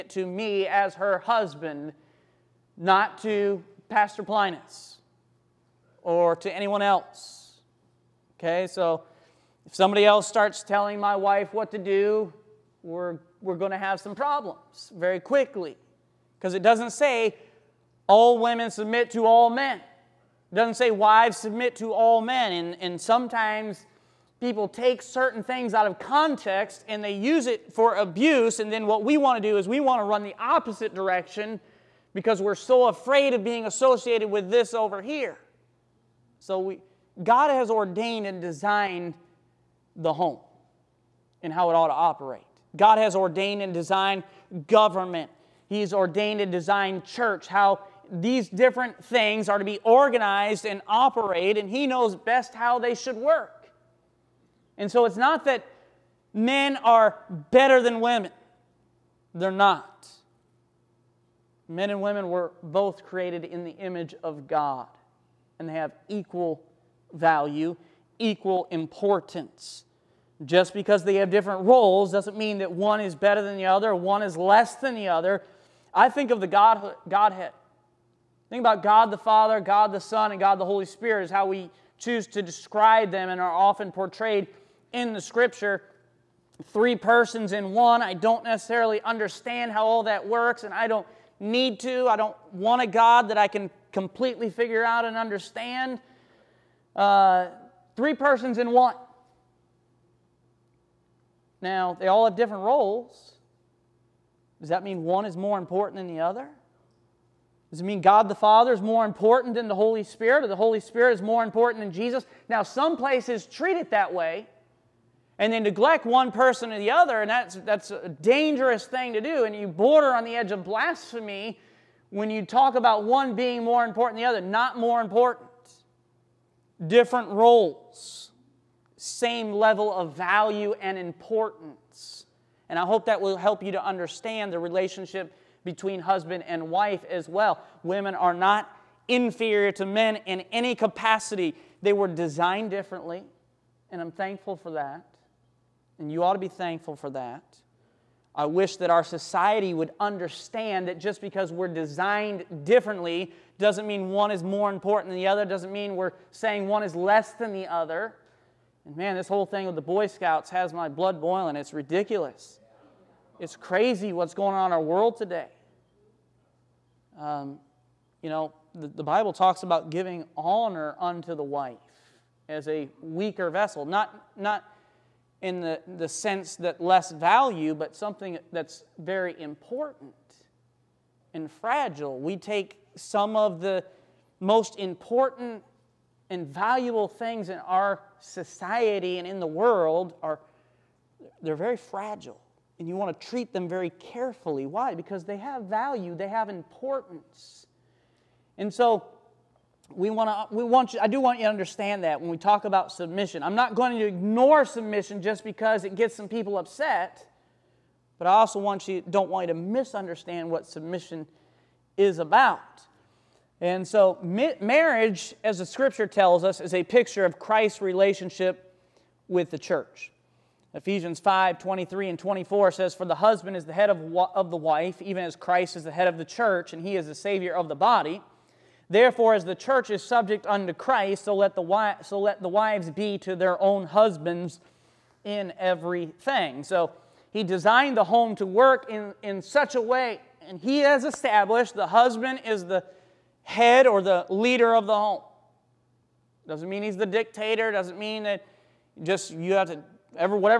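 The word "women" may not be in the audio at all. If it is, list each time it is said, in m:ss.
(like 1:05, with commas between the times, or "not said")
0:18, 0:57, 1:02, 2:17.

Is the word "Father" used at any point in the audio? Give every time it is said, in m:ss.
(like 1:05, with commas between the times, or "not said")
1:19, 1:48.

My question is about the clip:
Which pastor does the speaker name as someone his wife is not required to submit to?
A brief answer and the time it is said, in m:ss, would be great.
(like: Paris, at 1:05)
Pastor Plinus, at 0:03.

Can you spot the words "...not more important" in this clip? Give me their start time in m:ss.
2:04.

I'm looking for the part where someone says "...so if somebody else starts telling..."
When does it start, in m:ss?
0:08.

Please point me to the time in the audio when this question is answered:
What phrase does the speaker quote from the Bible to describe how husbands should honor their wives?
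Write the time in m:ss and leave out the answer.
2:52.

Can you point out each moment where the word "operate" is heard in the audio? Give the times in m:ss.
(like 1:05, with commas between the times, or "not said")
0:41, 0:50.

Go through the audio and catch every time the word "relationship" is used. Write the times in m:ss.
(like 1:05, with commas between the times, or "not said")
2:14, 3:37.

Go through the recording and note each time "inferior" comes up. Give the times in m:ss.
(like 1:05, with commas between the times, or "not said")
2:19.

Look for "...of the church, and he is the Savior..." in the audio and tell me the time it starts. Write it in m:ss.
3:46.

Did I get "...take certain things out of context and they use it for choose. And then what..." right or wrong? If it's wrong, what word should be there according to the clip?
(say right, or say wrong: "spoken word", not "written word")
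wrong: "abuse", not "choose".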